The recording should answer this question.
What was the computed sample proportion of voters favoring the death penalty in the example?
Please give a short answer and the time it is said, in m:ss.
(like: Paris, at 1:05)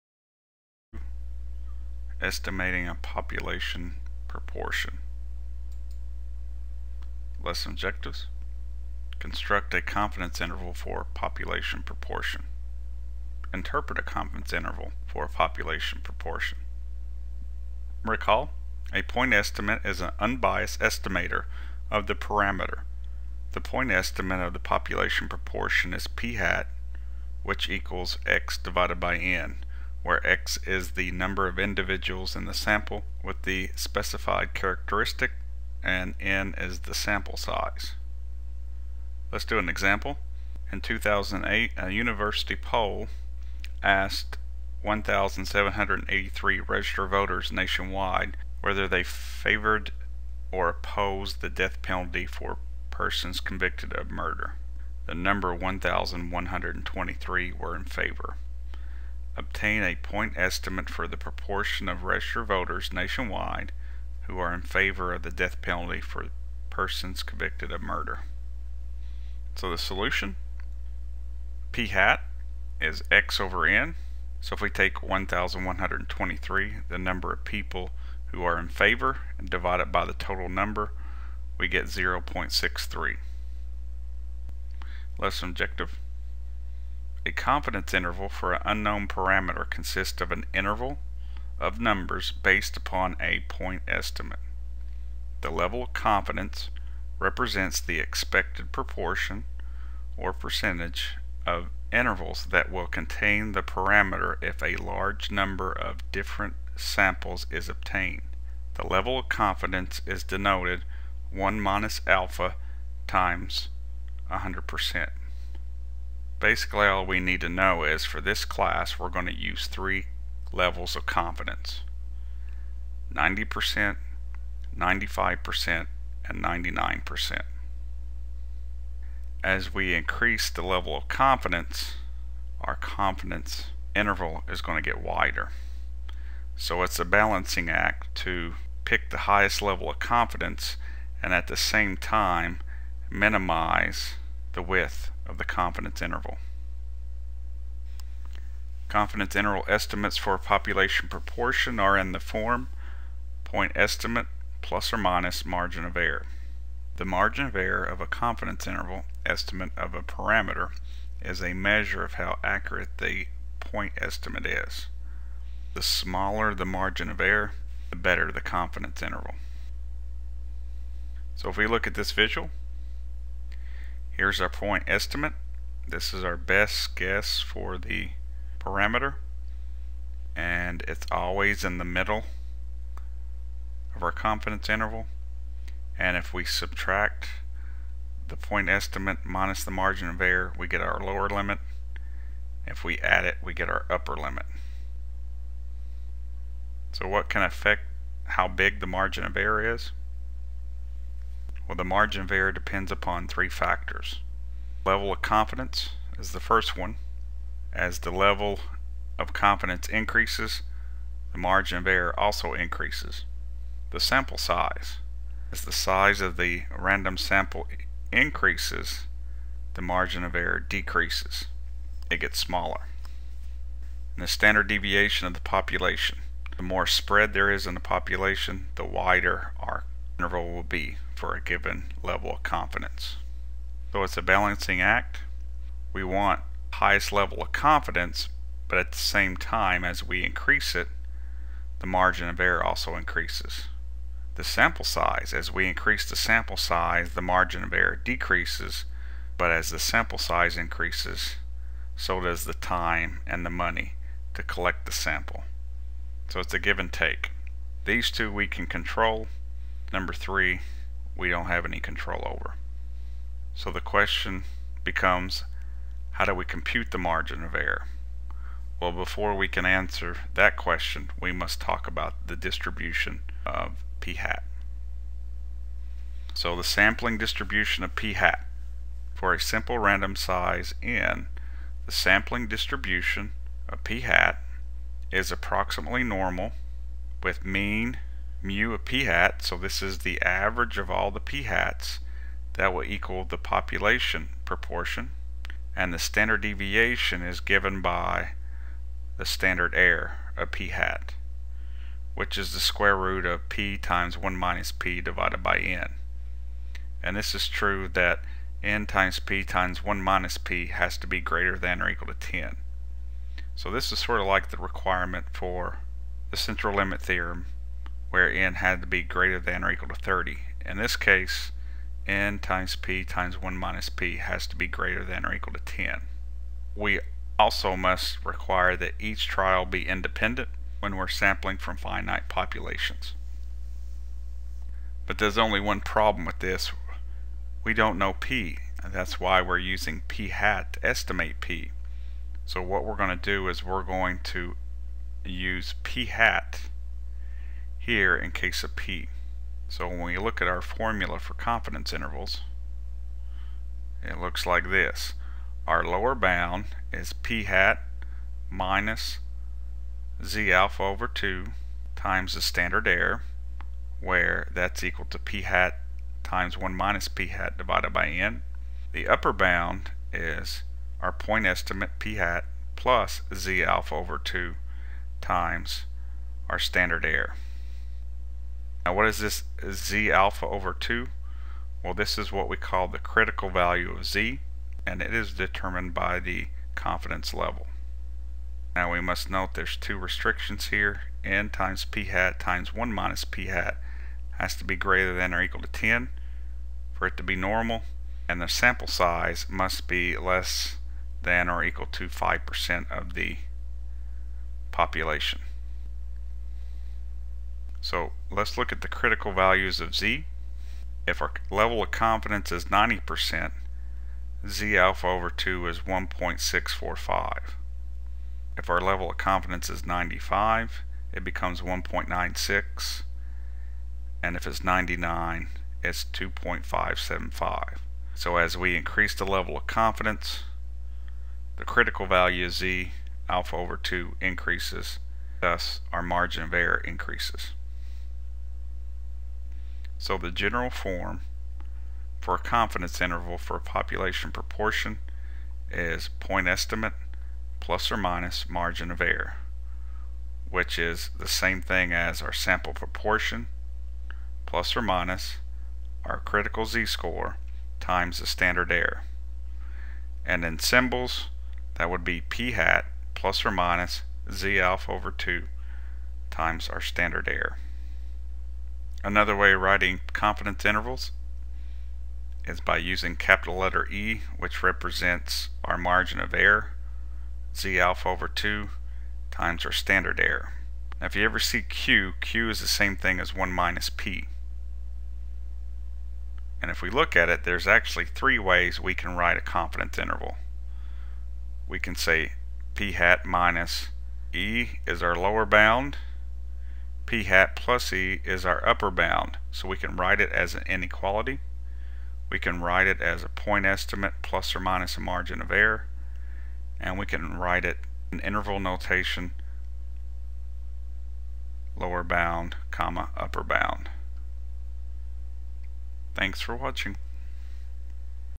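0.63, at 1:21.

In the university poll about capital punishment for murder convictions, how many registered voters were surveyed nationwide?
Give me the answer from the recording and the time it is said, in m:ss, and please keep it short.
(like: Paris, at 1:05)
1,783, at 0:44.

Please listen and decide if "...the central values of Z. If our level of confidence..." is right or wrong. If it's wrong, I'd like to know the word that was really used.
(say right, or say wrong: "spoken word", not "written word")
wrong: "critical", not "central".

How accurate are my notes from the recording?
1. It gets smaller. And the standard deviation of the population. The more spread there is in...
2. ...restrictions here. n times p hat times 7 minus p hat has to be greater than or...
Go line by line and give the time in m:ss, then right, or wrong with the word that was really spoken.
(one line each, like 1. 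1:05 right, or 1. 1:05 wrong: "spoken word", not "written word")
1. 3:42 right
2. 6:29 wrong: "1", not "7".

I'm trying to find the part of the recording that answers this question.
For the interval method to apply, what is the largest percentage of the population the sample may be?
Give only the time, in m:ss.
6:42.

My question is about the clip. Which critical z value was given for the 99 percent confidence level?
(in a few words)
2.575.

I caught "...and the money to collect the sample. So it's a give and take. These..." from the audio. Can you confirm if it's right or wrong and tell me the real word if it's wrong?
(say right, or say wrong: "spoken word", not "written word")
right.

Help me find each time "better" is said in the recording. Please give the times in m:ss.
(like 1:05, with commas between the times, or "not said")
2:47.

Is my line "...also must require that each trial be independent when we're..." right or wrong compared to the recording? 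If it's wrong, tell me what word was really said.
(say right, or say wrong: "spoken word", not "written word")
right.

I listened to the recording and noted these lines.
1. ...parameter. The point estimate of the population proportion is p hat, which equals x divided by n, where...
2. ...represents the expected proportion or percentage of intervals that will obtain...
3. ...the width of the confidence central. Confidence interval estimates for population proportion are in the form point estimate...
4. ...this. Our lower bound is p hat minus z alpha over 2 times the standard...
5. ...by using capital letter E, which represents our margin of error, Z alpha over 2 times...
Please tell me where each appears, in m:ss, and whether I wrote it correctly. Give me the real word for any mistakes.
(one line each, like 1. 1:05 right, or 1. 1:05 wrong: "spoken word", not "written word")
1. 0:22 right
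2. 1:37 wrong: "contain", not "obtain"
3. 2:24 wrong: "interval", not "central"
4. 5:54 right
5. 7:52 right.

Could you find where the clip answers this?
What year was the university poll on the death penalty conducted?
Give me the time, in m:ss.
0:40.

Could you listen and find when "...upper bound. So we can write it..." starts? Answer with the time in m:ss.
8:18.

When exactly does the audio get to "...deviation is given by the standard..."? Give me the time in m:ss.
4:56.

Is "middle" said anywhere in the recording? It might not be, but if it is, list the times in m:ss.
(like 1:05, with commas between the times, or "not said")
3:01.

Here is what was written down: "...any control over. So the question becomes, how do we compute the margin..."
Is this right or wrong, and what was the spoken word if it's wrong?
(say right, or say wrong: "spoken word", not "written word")
right.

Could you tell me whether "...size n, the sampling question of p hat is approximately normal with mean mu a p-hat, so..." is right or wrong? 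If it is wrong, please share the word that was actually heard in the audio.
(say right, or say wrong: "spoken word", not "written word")
wrong: "distribution", not "question".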